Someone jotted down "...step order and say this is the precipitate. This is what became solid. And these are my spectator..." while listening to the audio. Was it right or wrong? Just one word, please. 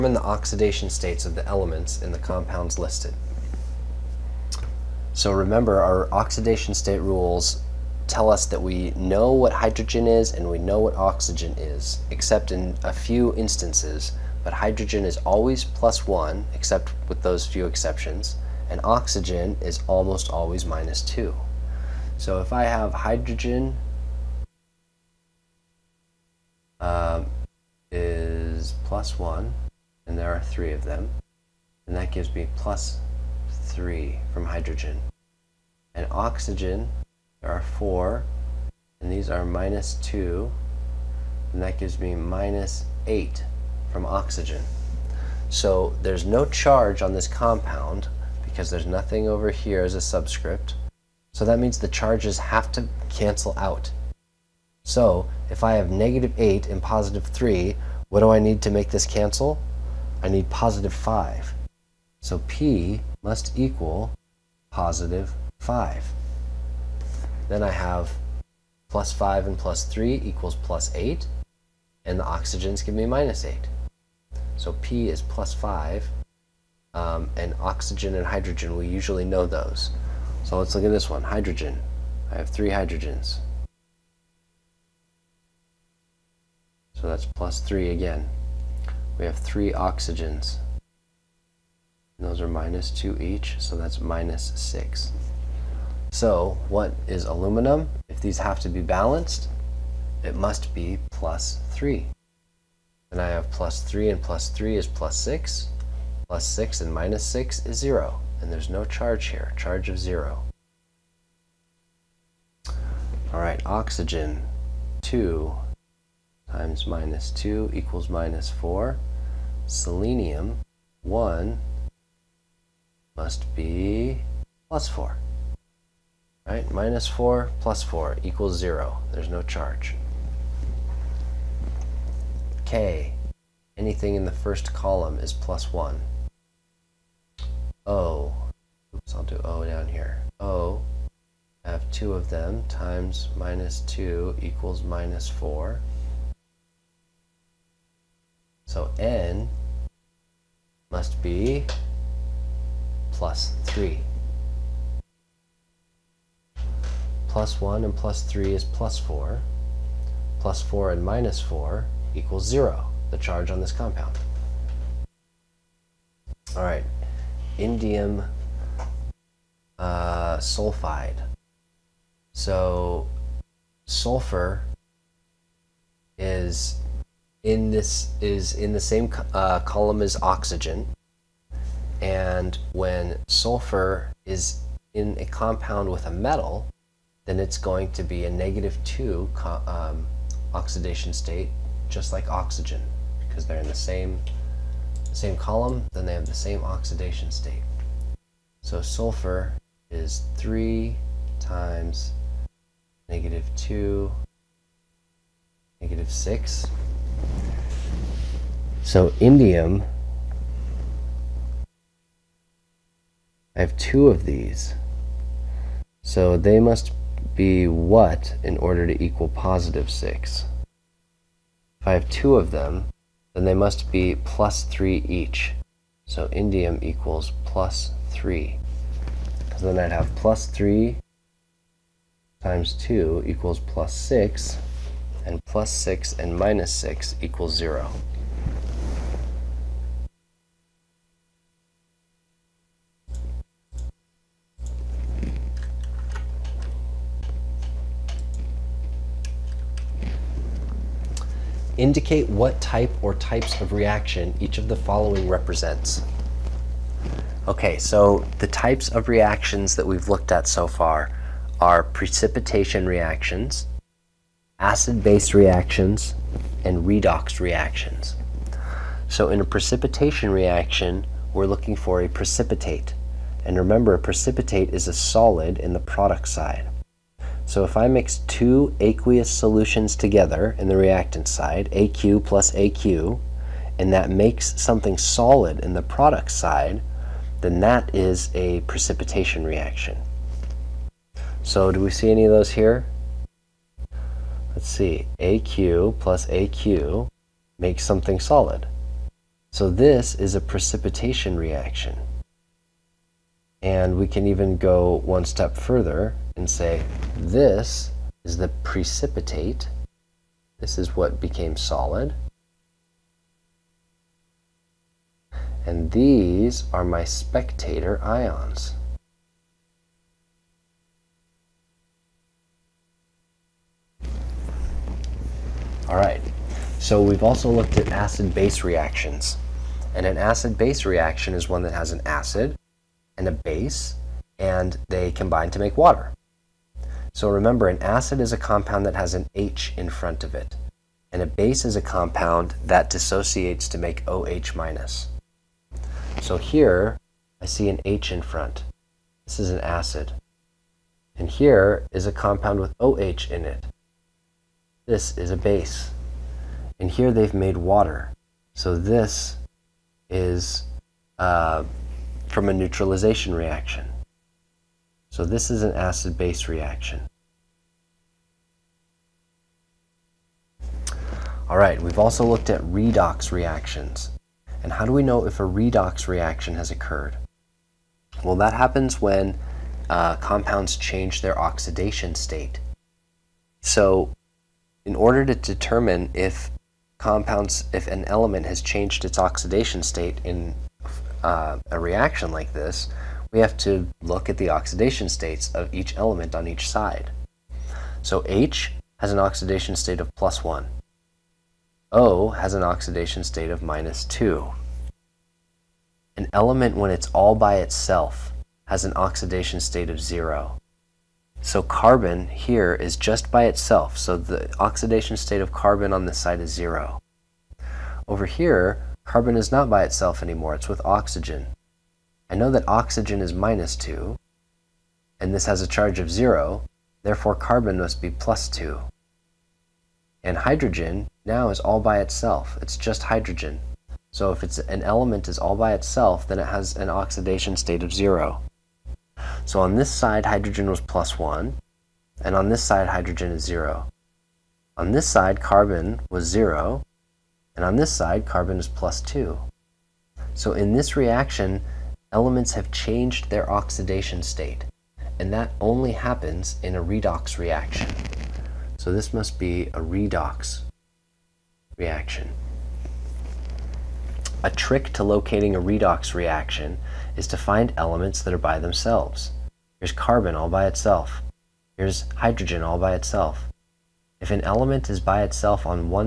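wrong.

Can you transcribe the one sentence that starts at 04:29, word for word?
So in a precipitation reaction, we're looking for a precipitate.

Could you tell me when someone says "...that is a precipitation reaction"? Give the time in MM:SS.
04:47.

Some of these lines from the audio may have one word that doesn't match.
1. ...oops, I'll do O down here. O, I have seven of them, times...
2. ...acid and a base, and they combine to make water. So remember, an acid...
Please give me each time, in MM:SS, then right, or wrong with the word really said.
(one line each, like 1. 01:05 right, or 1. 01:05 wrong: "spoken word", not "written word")
1. 02:18 wrong: "two", not "seven"
2. 05:32 right.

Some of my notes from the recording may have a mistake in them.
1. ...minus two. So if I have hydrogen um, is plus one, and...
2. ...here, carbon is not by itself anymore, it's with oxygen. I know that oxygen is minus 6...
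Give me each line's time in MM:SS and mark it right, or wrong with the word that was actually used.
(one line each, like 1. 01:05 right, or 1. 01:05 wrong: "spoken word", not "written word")
1. 00:20 right
2. 06:58 wrong: "2", not "6".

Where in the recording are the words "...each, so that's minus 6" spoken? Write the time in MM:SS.
01:33.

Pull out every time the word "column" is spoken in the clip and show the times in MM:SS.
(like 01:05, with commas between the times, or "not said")
02:14, 02:59, 03:15.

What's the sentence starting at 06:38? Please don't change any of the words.
So H has an oxidation state of plus 1.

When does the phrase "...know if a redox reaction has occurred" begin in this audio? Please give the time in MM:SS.
06:15.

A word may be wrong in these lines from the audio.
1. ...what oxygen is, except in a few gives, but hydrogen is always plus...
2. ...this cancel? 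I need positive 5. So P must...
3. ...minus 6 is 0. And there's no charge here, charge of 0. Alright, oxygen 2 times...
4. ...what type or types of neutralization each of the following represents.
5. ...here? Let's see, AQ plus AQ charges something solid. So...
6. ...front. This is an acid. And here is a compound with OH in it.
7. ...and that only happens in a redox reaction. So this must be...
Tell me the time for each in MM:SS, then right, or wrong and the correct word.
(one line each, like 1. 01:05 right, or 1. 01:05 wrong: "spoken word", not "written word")
1. 00:10 wrong: "instances", not "gives"
2. 00:58 right
3. 01:46 right
4. 04:12 wrong: "reaction", not "neutralization"
5. 04:52 wrong: "makes", not "charges"
6. 05:48 right
7. 07:35 right.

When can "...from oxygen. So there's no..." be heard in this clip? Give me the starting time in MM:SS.
00:43.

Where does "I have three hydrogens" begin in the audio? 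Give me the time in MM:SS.
01:22.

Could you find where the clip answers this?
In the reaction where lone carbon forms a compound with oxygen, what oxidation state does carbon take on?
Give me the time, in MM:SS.
07:07.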